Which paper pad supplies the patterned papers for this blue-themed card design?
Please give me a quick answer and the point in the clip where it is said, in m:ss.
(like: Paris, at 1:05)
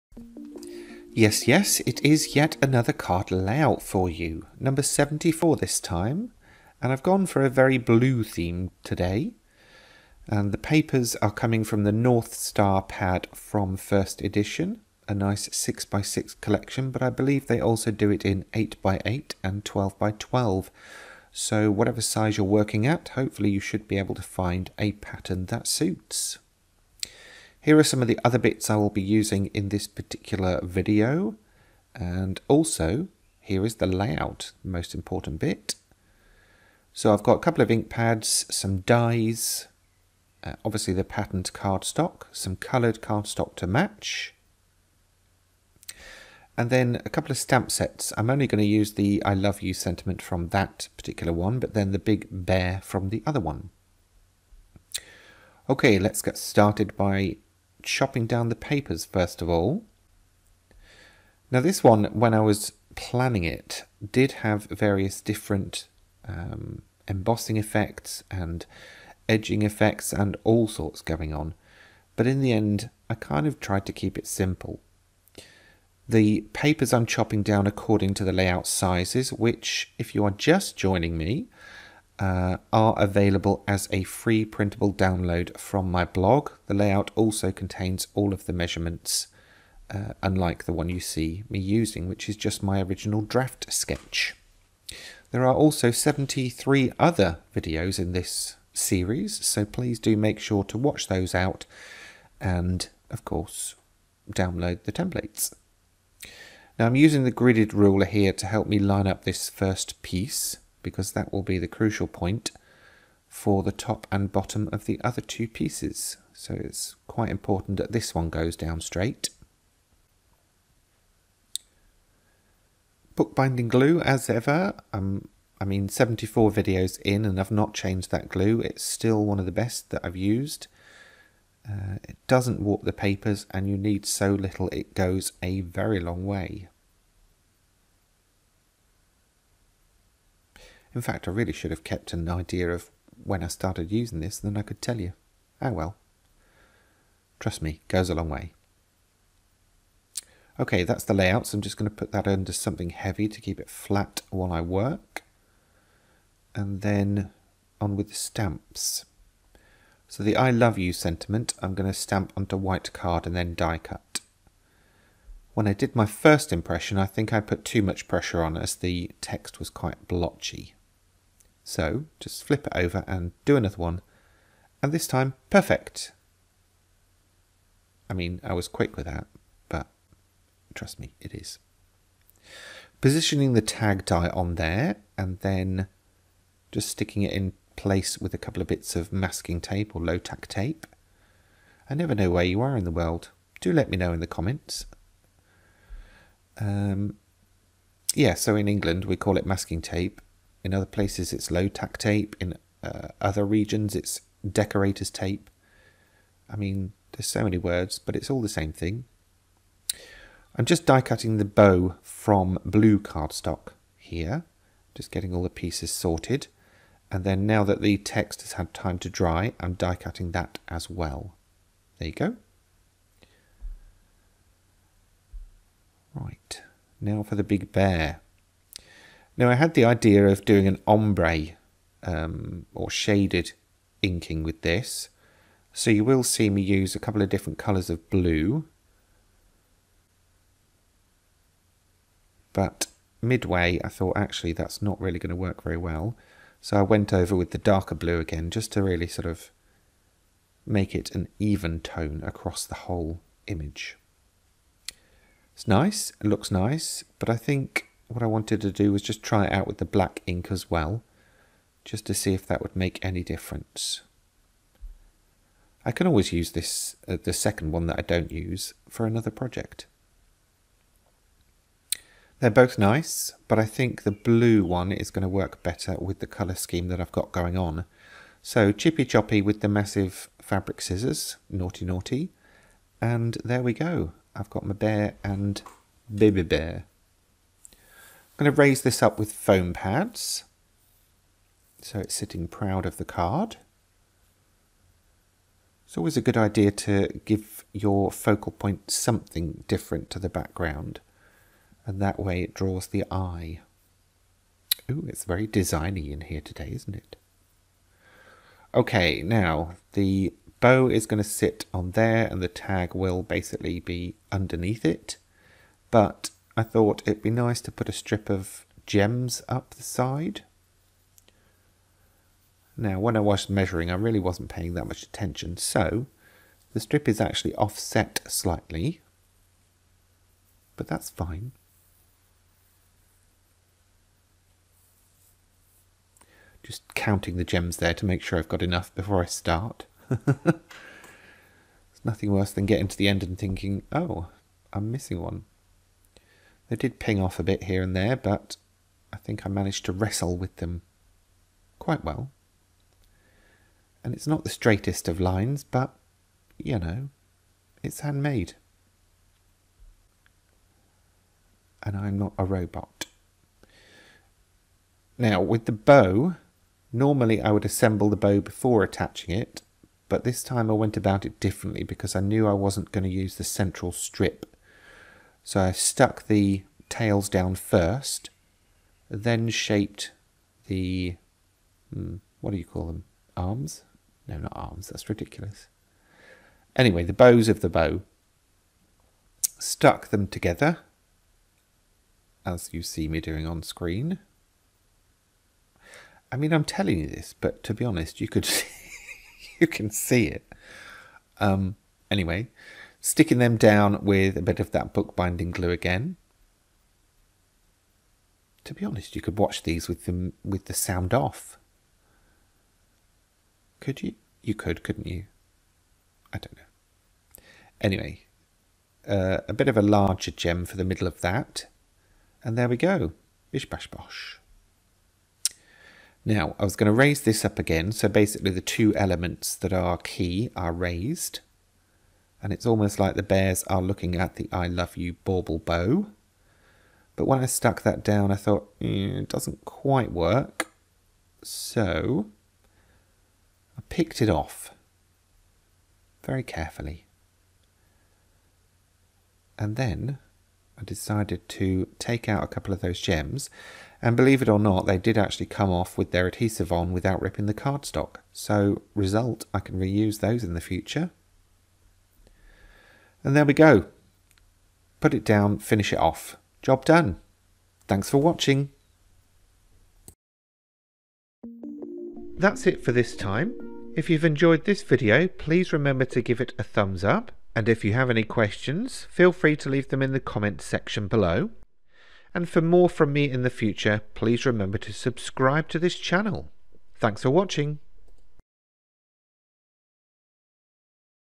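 North Star, at 0:11.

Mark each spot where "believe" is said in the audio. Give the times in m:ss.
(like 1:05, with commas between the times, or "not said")
0:17, 7:34.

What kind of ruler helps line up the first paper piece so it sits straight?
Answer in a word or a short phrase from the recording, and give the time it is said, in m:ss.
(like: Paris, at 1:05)
gridded ruler, at 1:47.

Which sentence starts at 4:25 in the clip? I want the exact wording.
I can always use this, uh, the second one that I don't use, for another project.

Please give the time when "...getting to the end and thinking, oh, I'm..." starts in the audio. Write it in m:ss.
5:42.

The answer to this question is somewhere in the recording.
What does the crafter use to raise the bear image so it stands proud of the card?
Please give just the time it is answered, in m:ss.
4:49.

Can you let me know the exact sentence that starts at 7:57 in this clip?
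And if you have any questions, feel free to leave them in the comments section below.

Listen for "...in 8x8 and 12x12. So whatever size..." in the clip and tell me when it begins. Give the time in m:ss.
0:18.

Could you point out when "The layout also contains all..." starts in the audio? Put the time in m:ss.
1:26.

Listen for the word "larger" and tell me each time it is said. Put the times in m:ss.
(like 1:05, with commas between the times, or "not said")
6:59.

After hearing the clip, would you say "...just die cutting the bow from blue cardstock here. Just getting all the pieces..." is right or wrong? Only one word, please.
right.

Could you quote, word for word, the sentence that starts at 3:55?
So you will see me use a couple of different colours of blue.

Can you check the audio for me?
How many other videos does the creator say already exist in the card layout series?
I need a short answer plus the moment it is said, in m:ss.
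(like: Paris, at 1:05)
73, at 1:35.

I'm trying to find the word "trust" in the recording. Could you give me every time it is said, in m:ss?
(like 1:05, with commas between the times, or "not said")
2:27, 3:00.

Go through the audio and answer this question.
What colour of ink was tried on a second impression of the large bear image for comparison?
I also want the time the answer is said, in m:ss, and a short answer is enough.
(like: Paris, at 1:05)
black, at 4:19.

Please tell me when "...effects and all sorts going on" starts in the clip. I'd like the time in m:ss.
1:09.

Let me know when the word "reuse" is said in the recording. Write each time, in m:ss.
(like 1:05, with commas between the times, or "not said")
7:39.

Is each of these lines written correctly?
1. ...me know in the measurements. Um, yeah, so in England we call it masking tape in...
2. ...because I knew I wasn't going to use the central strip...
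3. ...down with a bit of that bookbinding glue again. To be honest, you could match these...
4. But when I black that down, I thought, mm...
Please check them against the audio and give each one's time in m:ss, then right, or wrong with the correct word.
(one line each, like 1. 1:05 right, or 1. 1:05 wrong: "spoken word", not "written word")
1. 3:13 wrong: "comments", not "measurements"
2. 6:11 right
3. 6:43 wrong: "watch", not "match"
4. 7:17 wrong: "stuck", not "black".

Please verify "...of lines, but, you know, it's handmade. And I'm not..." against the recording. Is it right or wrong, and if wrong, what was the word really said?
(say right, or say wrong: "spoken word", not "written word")
right.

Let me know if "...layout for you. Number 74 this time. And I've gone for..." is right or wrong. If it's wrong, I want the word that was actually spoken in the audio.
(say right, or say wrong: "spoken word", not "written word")
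right.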